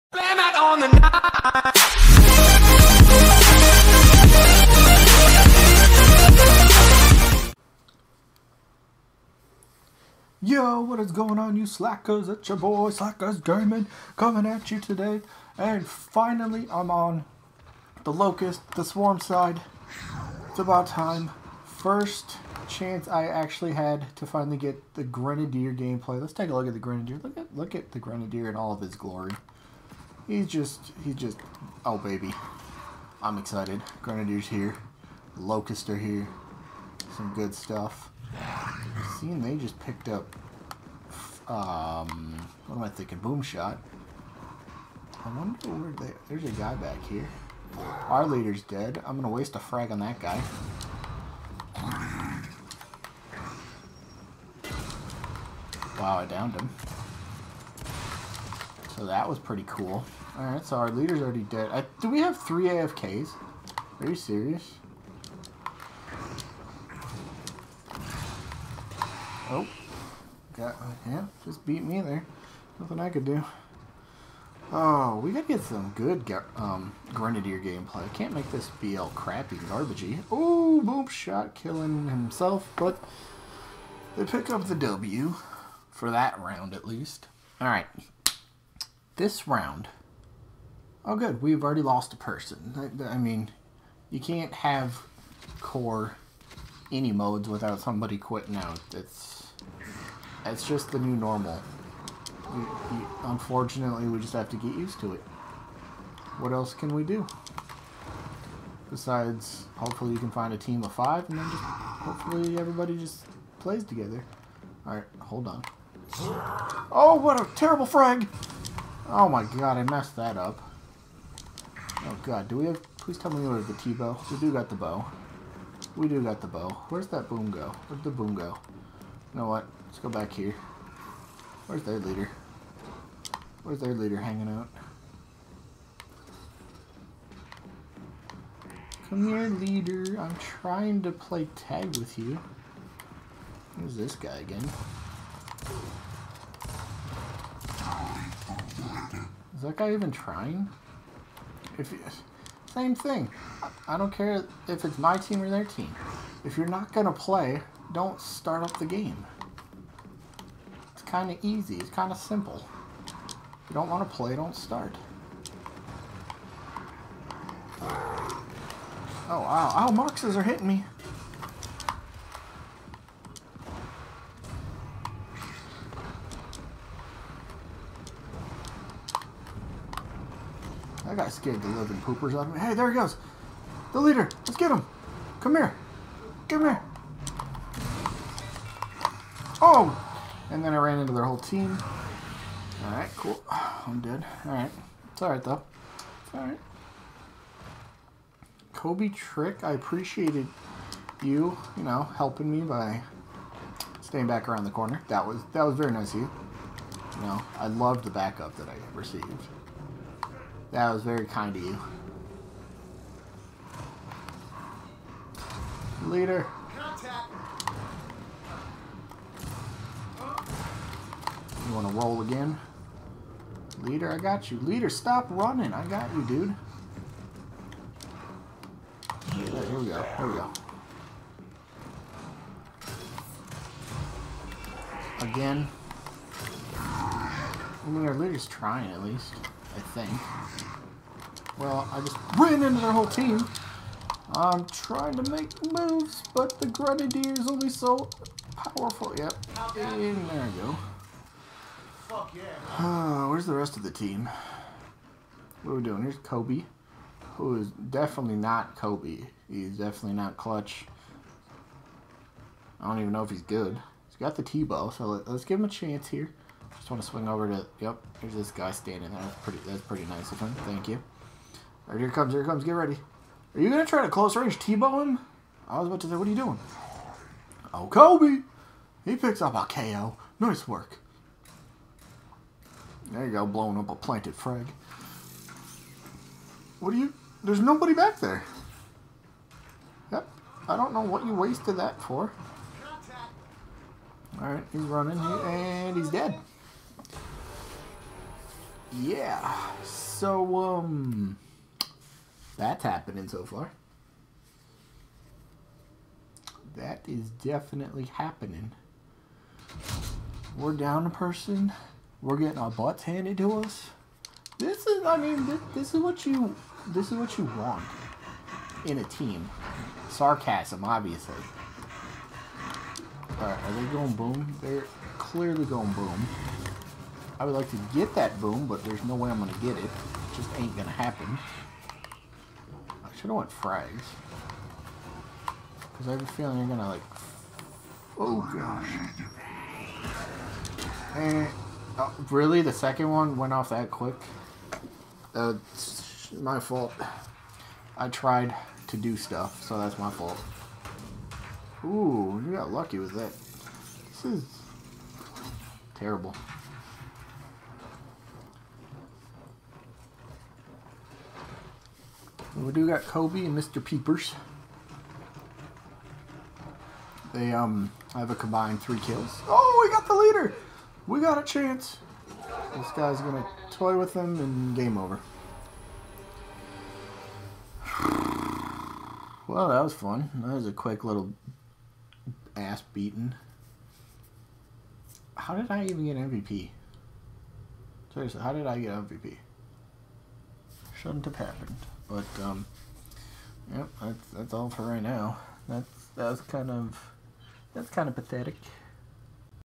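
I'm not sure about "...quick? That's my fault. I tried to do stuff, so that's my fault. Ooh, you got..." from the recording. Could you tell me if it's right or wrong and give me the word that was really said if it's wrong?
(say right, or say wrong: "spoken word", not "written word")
right.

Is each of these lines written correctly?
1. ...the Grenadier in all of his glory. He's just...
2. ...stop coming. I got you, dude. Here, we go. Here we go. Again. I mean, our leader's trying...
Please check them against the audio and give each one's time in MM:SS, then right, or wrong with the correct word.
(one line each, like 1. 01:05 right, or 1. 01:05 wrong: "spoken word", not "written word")
1. 00:27 right
2. 03:44 wrong: "running", not "coming".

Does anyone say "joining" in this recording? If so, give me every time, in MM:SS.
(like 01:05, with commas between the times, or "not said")
not said.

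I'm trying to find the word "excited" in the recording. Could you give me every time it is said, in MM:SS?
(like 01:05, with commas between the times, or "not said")
00:33.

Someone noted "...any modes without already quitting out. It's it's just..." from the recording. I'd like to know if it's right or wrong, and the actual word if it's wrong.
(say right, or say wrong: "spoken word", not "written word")
wrong: "somebody", not "already".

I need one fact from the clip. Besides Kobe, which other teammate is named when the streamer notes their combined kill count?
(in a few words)
Mr. Peepers.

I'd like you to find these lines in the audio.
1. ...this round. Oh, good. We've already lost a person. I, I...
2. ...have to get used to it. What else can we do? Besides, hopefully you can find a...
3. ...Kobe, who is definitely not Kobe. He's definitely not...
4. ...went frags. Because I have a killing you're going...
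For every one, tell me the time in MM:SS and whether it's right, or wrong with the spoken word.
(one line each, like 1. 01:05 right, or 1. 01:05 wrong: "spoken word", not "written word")
1. 01:29 right
2. 01:44 right
3. 04:16 right
4. 05:33 wrong: "feeling", not "killing".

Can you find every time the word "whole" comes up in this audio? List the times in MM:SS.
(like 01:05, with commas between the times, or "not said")
03:11, 04:02.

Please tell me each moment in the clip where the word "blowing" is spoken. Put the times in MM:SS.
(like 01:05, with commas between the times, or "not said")
04:43.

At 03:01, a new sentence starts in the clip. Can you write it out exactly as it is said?
I got scared the living poopers of me.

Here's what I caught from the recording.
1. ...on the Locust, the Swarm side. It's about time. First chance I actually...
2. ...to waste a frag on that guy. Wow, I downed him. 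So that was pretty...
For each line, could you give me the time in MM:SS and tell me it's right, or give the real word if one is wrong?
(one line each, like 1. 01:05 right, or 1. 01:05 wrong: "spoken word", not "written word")
1. 00:16 right
2. 00:49 right.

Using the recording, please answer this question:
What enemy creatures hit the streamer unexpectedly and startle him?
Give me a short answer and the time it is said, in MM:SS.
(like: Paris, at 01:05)
Moxes, at 02:49.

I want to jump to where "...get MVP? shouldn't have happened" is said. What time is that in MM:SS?
06:28.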